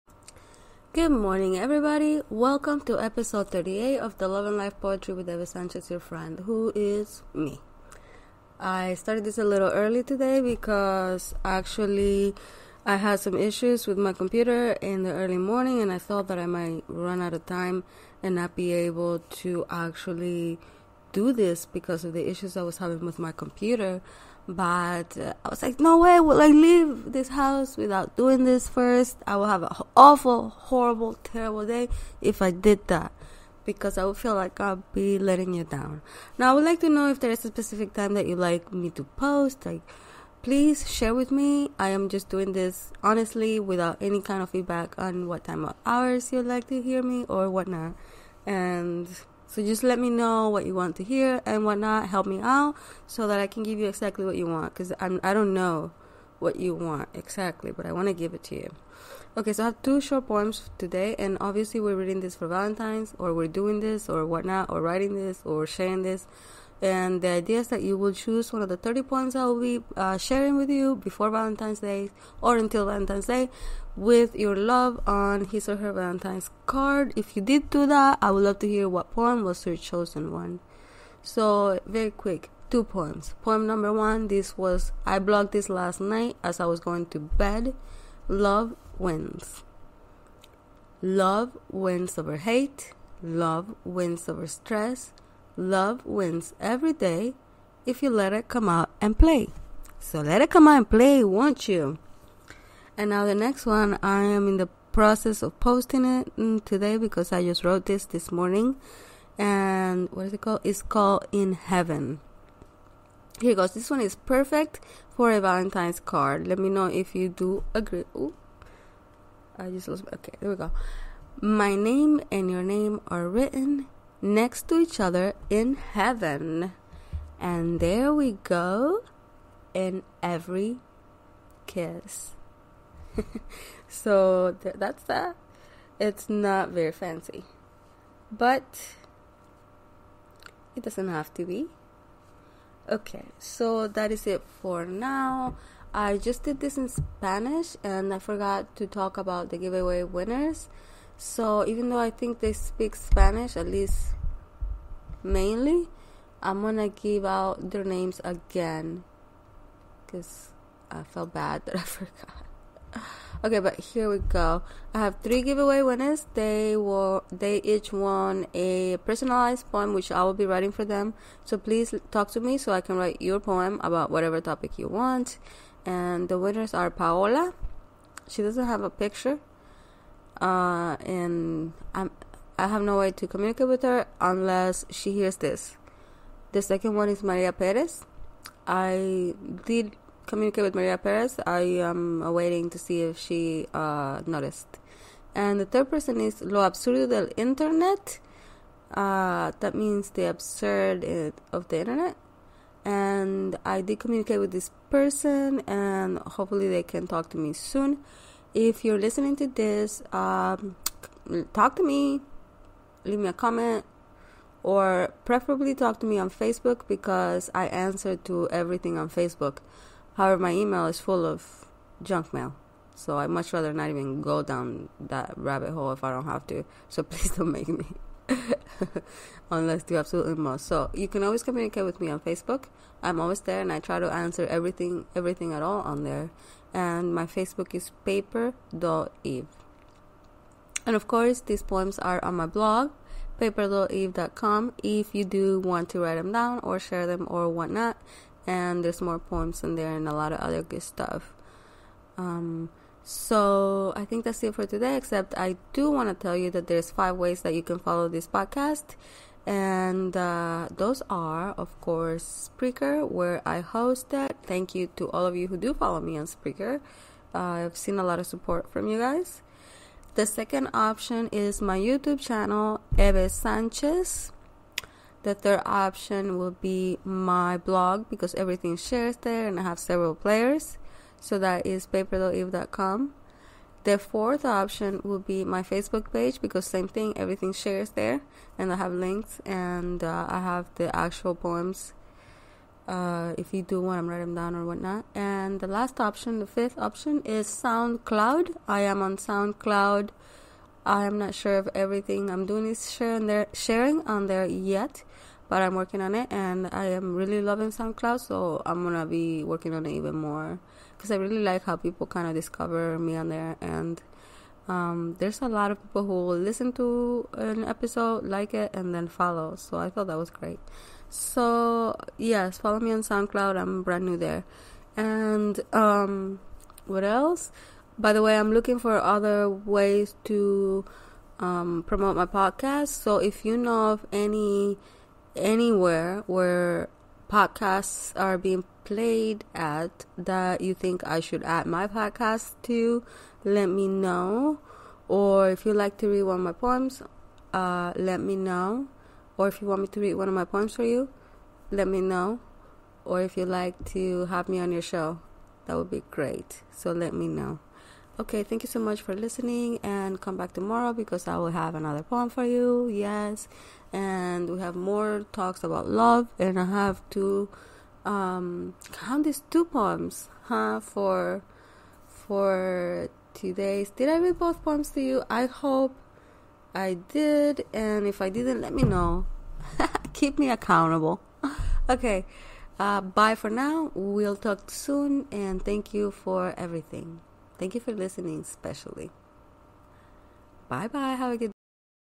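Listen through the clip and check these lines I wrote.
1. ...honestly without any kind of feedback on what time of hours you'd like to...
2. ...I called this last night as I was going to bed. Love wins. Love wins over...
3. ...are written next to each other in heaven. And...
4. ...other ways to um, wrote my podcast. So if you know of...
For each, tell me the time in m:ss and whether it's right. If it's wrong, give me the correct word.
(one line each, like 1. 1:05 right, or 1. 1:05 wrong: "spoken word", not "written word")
1. 0:43 right
2. 1:25 wrong: "blogged", not "called"
3. 2:03 right
4. 5:28 wrong: "promote", not "wrote".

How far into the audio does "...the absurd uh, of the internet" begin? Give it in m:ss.
3:20.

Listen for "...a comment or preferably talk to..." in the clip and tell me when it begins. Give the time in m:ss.
3:33.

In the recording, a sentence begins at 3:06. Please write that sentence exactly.
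The second one is Maria Perez.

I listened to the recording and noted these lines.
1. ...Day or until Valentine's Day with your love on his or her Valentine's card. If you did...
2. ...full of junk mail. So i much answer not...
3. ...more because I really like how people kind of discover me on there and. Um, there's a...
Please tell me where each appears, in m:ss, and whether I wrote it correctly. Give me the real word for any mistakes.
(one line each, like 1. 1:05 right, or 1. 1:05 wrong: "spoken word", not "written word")
1. 1:11 right
2. 3:40 wrong: "rather", not "answer"
3. 5:10 right.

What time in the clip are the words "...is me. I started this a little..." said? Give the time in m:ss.
0:06.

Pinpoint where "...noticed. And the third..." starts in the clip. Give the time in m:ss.
3:14.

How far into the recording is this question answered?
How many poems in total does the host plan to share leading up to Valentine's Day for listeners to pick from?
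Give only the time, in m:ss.
1:08.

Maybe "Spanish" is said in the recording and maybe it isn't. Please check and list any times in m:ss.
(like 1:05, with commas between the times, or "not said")
2:26, 2:32.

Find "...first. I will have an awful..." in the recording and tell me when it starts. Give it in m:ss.
0:28.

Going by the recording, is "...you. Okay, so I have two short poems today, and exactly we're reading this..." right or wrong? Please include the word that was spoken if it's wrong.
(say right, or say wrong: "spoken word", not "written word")
wrong: "obviously", not "exactly".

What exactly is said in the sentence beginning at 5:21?
So yes, follow me on SoundCloud.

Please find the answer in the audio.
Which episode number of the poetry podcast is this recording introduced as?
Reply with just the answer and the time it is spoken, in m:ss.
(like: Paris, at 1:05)
38, at 0:02.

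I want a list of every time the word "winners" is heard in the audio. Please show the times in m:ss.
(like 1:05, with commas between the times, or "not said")
2:30, 2:45, 2:56.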